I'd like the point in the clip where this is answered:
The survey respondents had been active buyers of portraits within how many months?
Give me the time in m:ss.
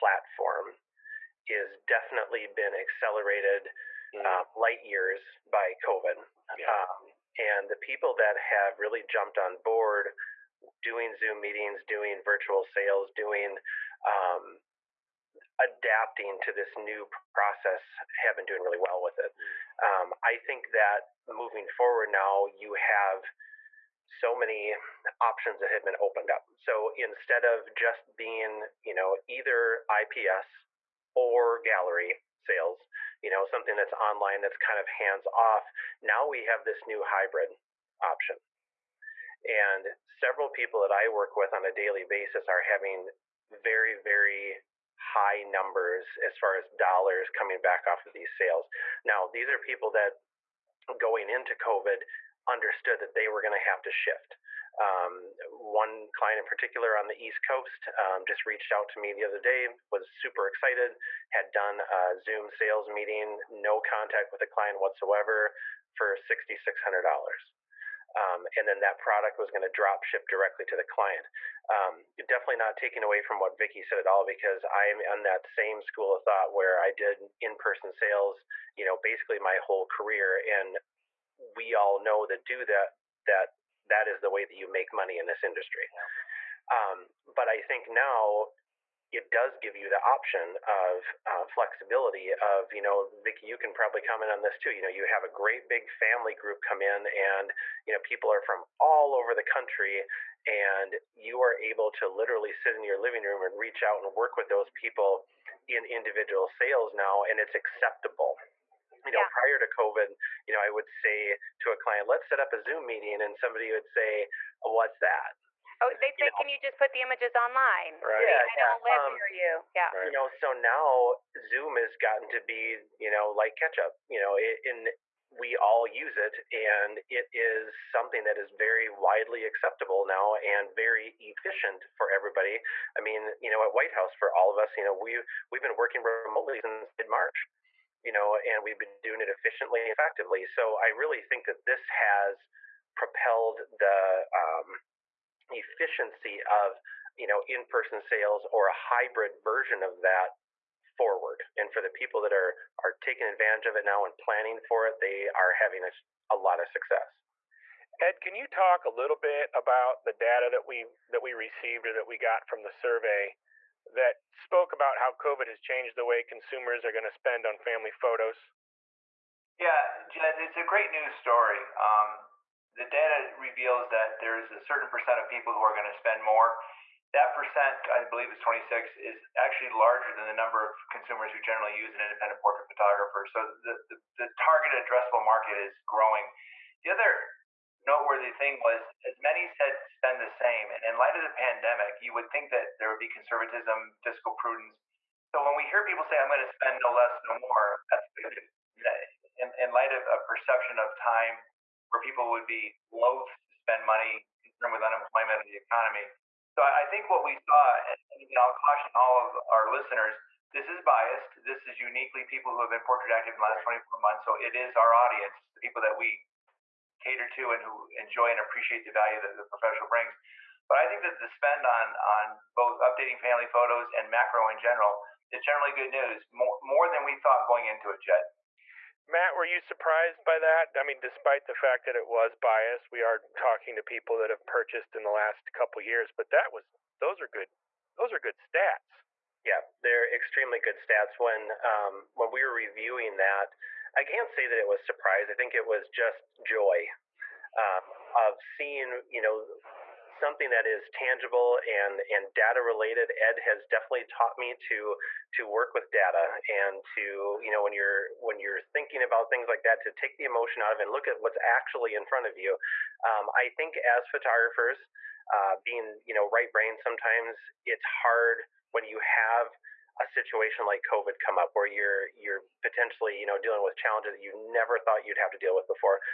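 3:33.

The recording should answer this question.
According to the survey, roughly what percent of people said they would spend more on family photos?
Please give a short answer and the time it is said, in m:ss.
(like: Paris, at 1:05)
26, at 2:58.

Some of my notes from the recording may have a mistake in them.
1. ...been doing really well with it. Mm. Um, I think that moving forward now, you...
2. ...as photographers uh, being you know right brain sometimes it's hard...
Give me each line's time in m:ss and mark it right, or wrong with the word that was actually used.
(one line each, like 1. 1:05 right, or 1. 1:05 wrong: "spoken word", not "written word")
1. 0:18 right
2. 4:23 right.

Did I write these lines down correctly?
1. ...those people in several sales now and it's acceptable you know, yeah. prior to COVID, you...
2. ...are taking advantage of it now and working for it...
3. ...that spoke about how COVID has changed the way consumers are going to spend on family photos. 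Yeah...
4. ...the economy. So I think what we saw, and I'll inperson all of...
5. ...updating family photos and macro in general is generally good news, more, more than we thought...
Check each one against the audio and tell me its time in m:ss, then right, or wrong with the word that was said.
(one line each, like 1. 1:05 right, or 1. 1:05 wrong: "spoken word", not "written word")
1. 1:44 wrong: "individual", not "several"
2. 2:32 wrong: "planning", not "working"
3. 2:43 right
4. 3:25 wrong: "caution", not "inperson"
5. 3:42 right.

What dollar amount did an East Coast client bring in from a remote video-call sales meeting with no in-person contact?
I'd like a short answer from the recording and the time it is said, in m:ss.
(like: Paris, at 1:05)
$6,600, at 1:06.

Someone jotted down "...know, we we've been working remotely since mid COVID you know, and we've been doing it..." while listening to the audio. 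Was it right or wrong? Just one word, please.
wrong.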